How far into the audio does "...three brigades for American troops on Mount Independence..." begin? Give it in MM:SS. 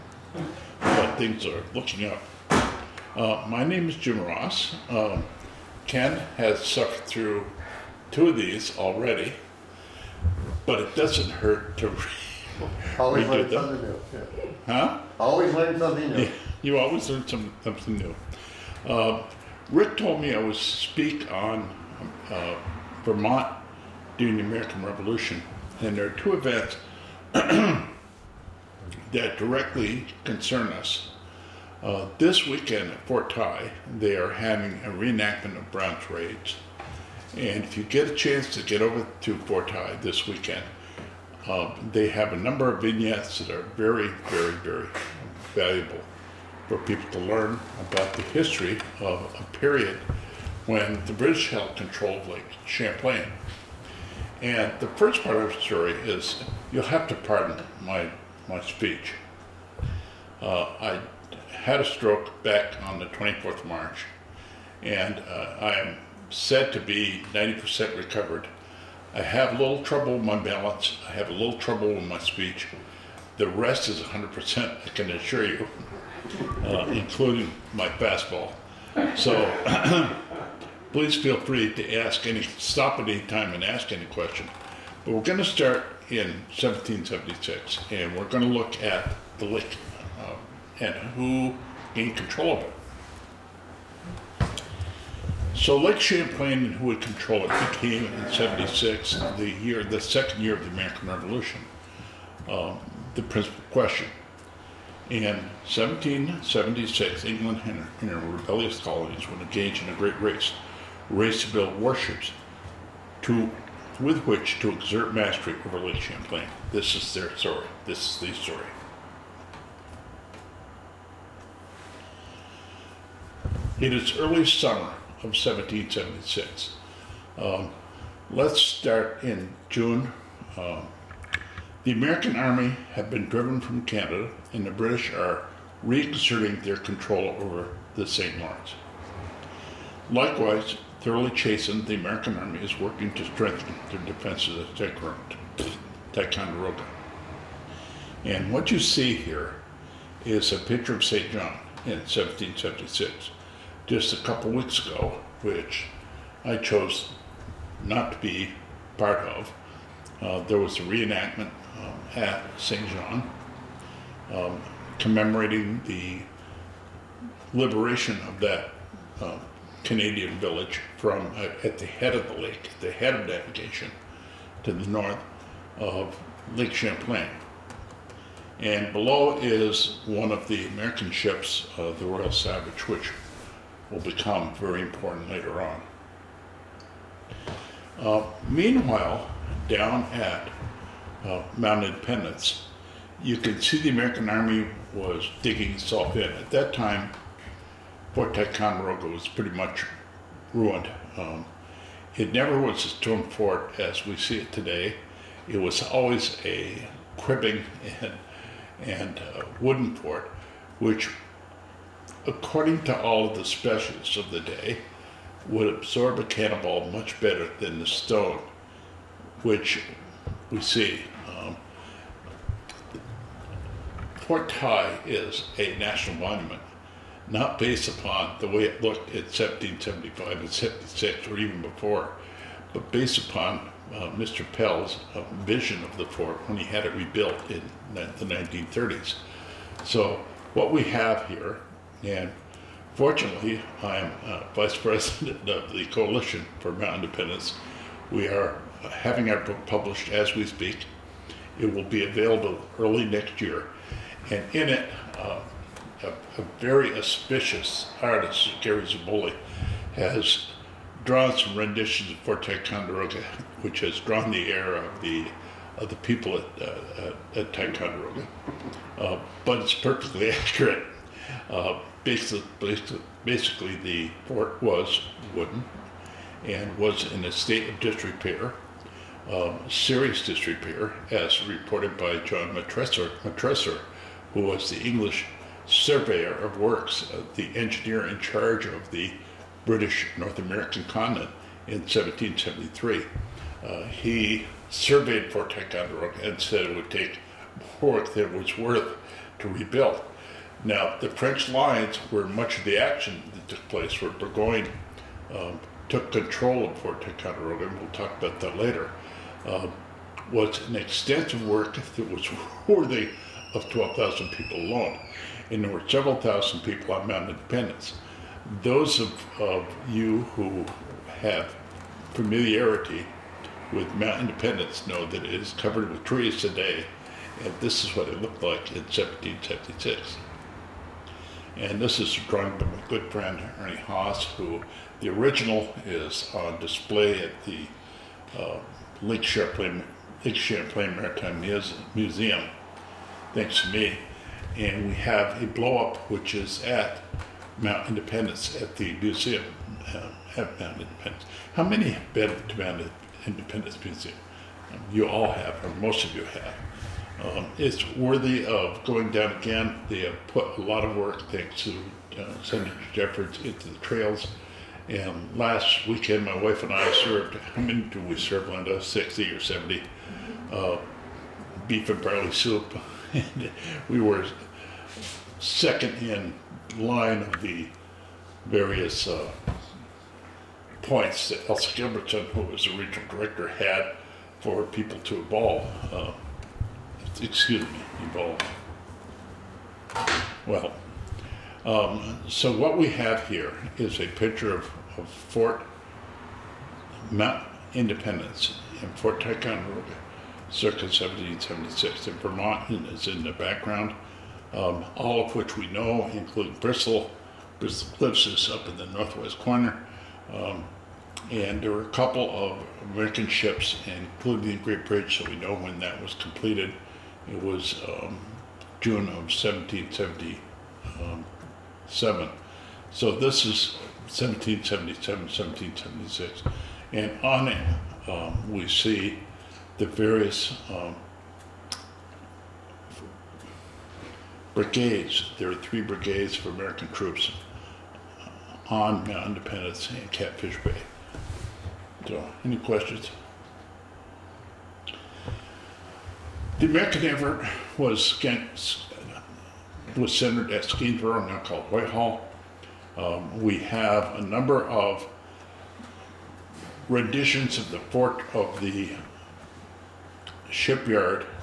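07:15.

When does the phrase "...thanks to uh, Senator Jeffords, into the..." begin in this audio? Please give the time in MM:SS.
06:01.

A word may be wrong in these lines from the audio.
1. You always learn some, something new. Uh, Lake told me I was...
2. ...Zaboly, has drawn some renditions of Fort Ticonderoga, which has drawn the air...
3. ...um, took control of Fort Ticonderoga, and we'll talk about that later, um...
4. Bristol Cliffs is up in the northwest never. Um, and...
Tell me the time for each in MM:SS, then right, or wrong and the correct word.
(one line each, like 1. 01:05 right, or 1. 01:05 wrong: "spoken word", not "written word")
1. 00:16 wrong: "Rick", not "Lake"
2. 04:18 right
3. 05:05 right
4. 06:47 wrong: "corner", not "never".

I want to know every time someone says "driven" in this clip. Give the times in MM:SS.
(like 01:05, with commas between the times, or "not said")
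02:13.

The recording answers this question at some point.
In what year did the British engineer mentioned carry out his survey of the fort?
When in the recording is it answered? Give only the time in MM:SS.
04:51.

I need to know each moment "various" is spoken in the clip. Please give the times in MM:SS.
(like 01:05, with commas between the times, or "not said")
06:18, 07:09.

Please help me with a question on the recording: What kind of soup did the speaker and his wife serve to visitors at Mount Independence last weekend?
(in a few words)
Beef and barley.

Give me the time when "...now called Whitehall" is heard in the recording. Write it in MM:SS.
07:31.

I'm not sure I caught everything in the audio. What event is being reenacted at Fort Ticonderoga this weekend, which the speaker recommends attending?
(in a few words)
Brown's raids.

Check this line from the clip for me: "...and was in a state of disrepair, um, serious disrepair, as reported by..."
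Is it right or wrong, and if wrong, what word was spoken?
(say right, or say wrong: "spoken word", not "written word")
right.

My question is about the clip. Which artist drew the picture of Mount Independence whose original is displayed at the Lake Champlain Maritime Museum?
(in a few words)
Ernie Haas.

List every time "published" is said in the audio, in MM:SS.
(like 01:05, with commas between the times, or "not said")
04:09.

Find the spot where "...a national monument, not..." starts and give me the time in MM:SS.
03:45.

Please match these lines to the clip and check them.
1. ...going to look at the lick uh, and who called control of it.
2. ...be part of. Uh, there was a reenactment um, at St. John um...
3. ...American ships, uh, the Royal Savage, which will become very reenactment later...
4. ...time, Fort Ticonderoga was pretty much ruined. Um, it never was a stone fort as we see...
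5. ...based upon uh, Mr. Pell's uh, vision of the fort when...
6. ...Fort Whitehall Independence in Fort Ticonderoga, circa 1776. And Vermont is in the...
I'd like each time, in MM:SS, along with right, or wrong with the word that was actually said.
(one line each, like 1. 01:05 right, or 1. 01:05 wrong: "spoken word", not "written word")
1. 01:28 wrong: "gained", not "called"
2. 02:38 right
3. 03:00 wrong: "important", not "reenactment"
4. 03:16 right
5. 03:52 right
6. 06:35 wrong: "Mount", not "Whitehall".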